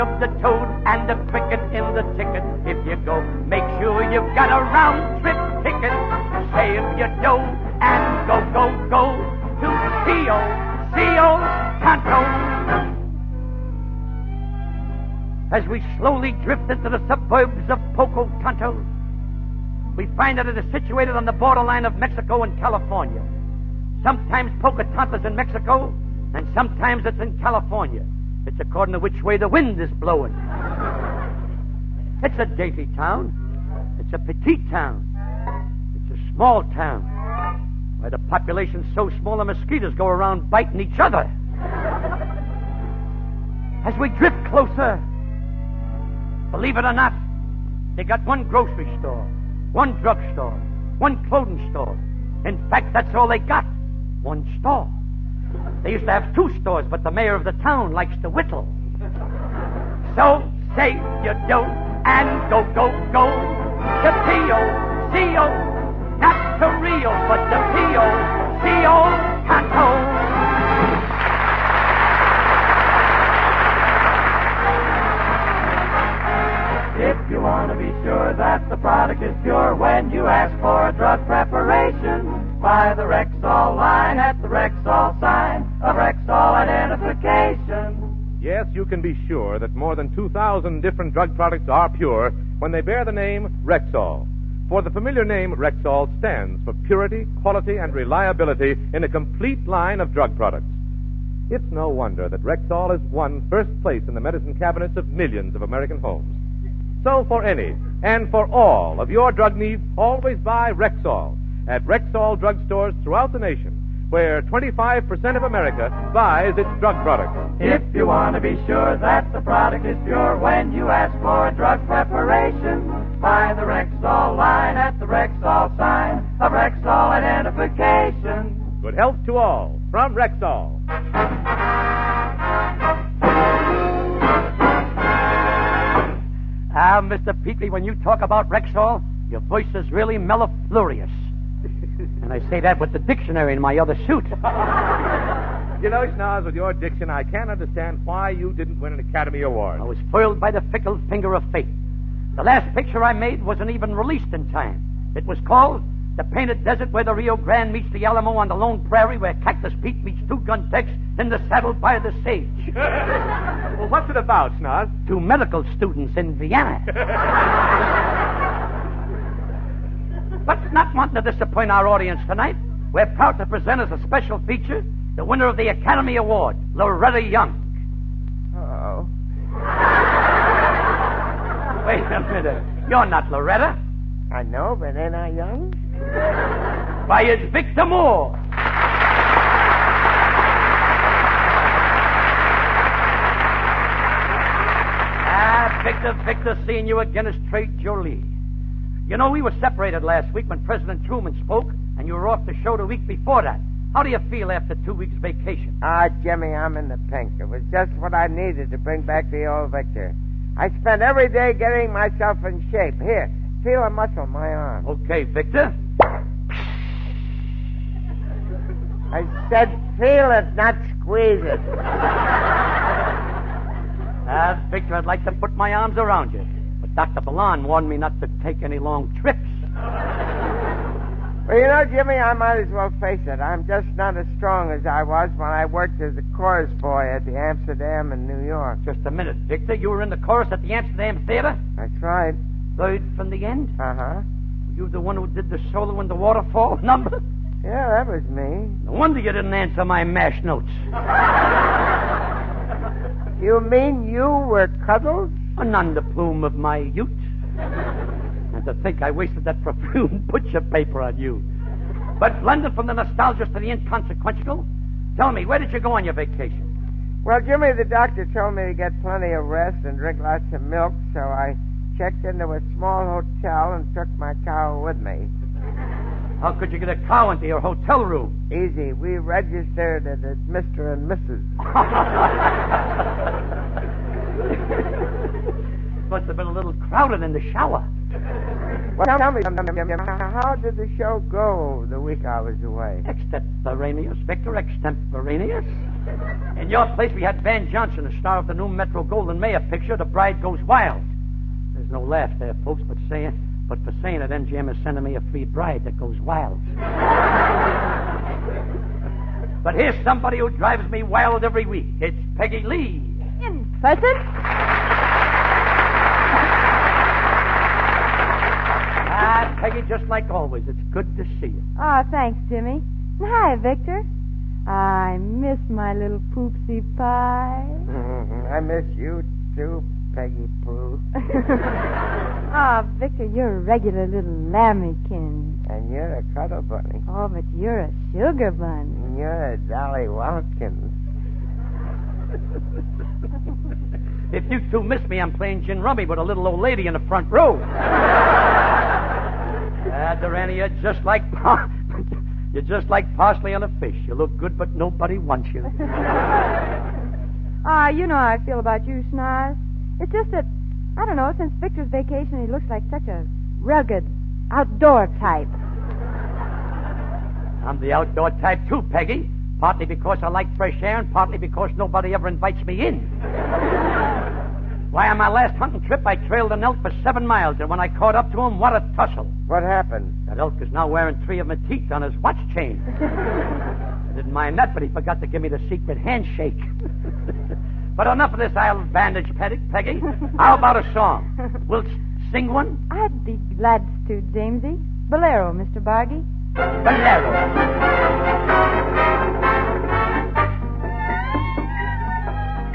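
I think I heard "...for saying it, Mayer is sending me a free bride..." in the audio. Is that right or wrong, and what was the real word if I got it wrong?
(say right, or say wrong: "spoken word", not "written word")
wrong: "MGM", not "Mayer".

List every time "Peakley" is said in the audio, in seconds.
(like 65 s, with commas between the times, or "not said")
137 s.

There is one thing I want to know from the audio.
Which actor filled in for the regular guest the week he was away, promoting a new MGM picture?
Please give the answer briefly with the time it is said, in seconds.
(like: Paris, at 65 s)
Van Johnson, at 297 s.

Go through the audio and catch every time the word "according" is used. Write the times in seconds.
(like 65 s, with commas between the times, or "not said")
28 s.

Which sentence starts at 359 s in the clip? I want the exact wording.
It's just that I don't know.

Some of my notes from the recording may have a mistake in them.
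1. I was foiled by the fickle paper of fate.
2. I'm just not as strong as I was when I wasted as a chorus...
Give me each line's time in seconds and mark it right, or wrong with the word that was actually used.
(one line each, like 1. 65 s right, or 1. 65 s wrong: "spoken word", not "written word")
1. 149 s wrong: "finger", not "paper"
2. 233 s wrong: "worked", not "wasted".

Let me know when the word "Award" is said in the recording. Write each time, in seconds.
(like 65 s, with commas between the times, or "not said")
149 s, 176 s.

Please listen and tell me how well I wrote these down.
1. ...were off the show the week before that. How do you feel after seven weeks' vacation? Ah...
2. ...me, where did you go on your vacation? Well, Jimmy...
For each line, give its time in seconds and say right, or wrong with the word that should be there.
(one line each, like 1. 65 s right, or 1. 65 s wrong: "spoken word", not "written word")
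1. 202 s wrong: "two", not "seven"
2. 265 s right.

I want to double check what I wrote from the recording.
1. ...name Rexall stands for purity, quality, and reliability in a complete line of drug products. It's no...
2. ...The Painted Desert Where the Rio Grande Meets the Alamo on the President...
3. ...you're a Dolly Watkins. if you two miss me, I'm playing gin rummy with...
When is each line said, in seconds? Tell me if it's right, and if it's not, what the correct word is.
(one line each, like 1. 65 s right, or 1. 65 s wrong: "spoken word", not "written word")
1. 95 s right
2. 156 s wrong: "Lone", not "President"
3. 339 s right.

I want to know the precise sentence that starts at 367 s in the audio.
I'm the outdoor type too, Peggy.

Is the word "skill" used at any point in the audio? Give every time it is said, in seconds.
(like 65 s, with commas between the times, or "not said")
not said.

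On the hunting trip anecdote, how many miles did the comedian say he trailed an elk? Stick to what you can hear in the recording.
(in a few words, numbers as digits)
7.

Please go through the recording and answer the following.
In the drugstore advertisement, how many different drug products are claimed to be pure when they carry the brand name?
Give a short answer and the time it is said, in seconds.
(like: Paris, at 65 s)
2,000, at 90 s.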